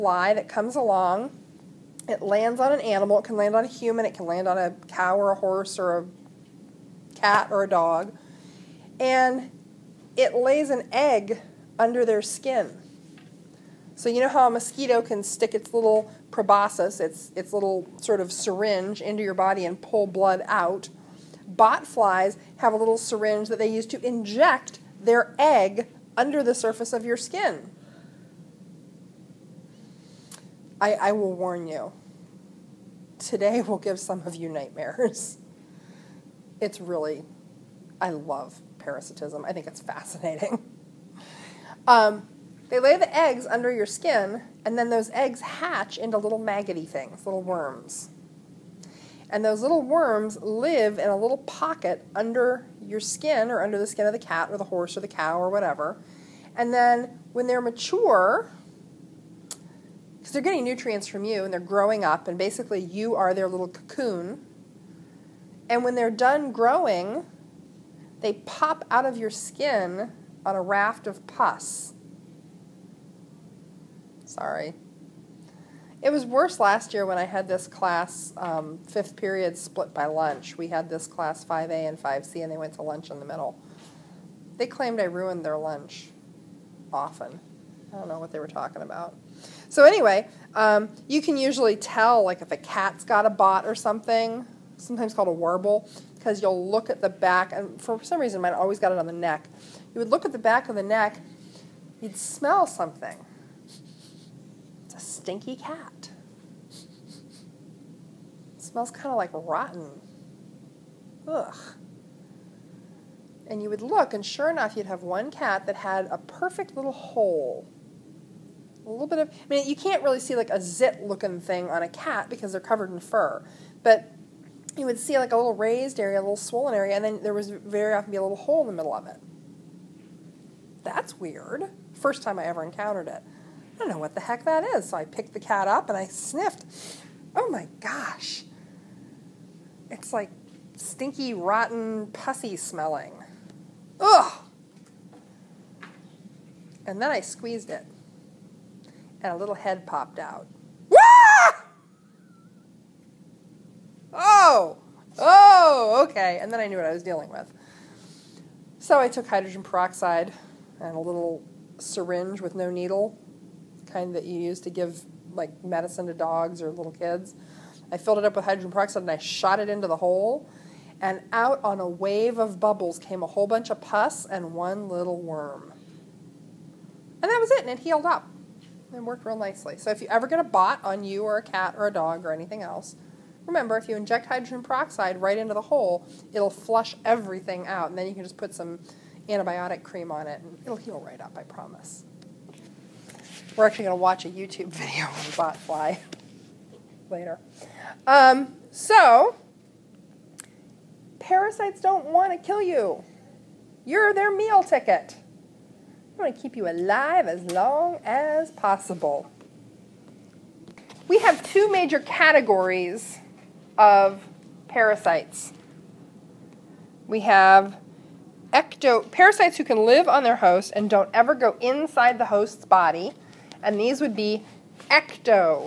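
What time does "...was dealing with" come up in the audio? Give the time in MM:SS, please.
02:36.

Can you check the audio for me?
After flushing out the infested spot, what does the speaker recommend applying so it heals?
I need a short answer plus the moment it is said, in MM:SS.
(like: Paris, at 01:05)
antibiotic cream, at 03:09.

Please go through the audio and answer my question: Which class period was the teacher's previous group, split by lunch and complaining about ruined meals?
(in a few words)
fifth period.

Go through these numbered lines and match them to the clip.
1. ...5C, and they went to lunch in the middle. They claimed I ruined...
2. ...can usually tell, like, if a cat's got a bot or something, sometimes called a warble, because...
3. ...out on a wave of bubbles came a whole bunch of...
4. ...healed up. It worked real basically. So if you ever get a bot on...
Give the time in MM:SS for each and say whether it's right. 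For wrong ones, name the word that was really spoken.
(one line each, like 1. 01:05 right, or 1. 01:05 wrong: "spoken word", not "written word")
1. 01:22 right
2. 01:31 right
3. 02:51 right
4. 02:57 wrong: "nicely", not "basically".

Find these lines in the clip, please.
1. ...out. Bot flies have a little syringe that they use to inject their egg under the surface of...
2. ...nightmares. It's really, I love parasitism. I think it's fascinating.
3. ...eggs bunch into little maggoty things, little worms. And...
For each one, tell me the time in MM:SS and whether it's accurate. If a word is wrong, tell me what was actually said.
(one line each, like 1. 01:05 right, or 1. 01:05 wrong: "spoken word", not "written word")
1. 00:20 right
2. 00:34 right
3. 00:45 wrong: "hatch", not "bunch".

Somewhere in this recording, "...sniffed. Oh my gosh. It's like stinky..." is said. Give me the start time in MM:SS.
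02:16.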